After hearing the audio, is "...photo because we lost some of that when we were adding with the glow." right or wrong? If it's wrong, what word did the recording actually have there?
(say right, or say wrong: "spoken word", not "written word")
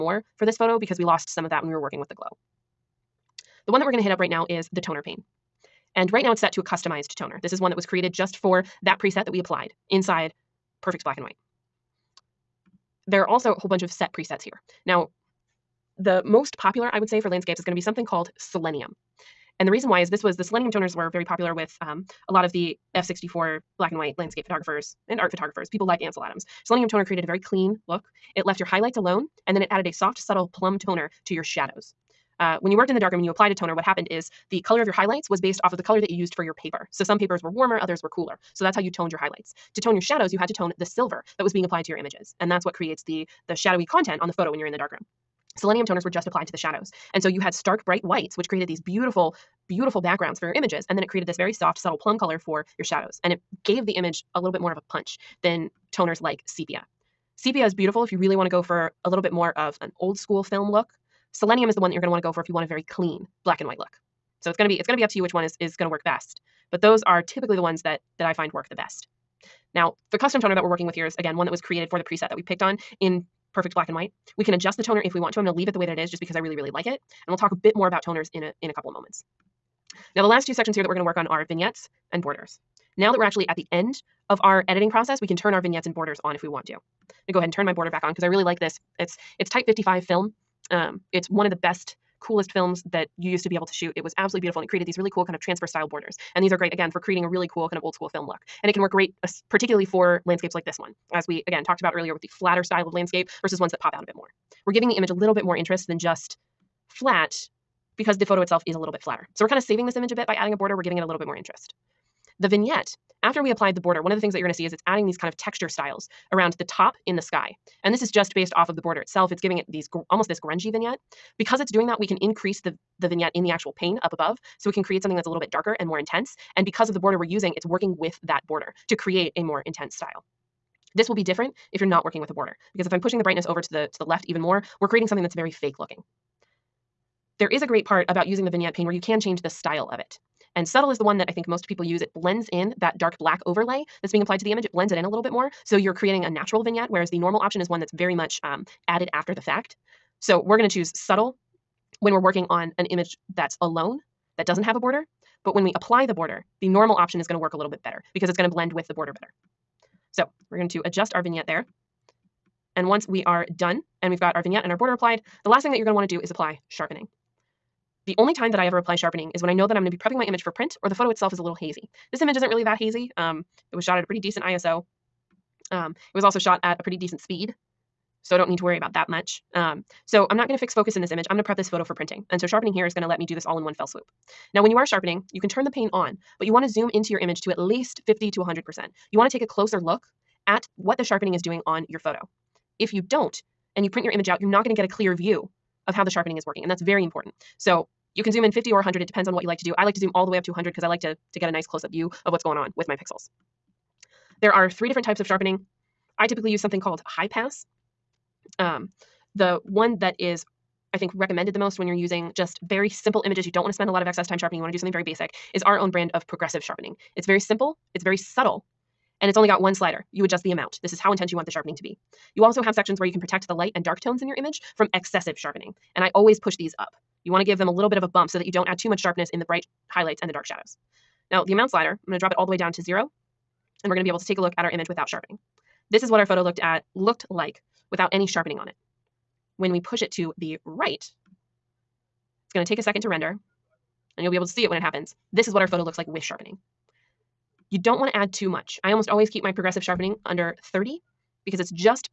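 wrong: "working", not "adding".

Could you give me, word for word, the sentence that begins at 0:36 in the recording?
So some papers were warmer, others were cooler.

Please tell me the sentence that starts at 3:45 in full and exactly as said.
And I always push these up.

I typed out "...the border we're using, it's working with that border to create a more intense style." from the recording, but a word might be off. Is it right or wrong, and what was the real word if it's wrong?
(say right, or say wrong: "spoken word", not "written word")
right.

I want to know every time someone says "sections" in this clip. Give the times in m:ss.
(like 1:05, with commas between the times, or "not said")
1:20, 3:42.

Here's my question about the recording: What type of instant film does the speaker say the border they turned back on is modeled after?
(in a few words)
Type 55.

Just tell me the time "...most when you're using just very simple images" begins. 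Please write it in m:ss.
3:31.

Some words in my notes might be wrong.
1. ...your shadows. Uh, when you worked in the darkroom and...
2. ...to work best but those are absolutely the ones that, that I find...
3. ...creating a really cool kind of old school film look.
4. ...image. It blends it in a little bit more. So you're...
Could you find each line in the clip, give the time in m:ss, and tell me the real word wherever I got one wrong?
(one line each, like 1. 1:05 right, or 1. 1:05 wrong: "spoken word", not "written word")
1. 0:31 right
2. 1:05 wrong: "typically", not "absolutely"
3. 1:36 right
4. 2:24 right.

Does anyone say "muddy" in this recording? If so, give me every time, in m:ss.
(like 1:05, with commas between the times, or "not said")
not said.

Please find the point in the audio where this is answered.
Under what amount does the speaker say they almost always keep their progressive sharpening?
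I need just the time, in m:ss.
4:10.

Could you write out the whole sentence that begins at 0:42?
And that's what creates the, the shadowy content on the photo when you're in the darkroom.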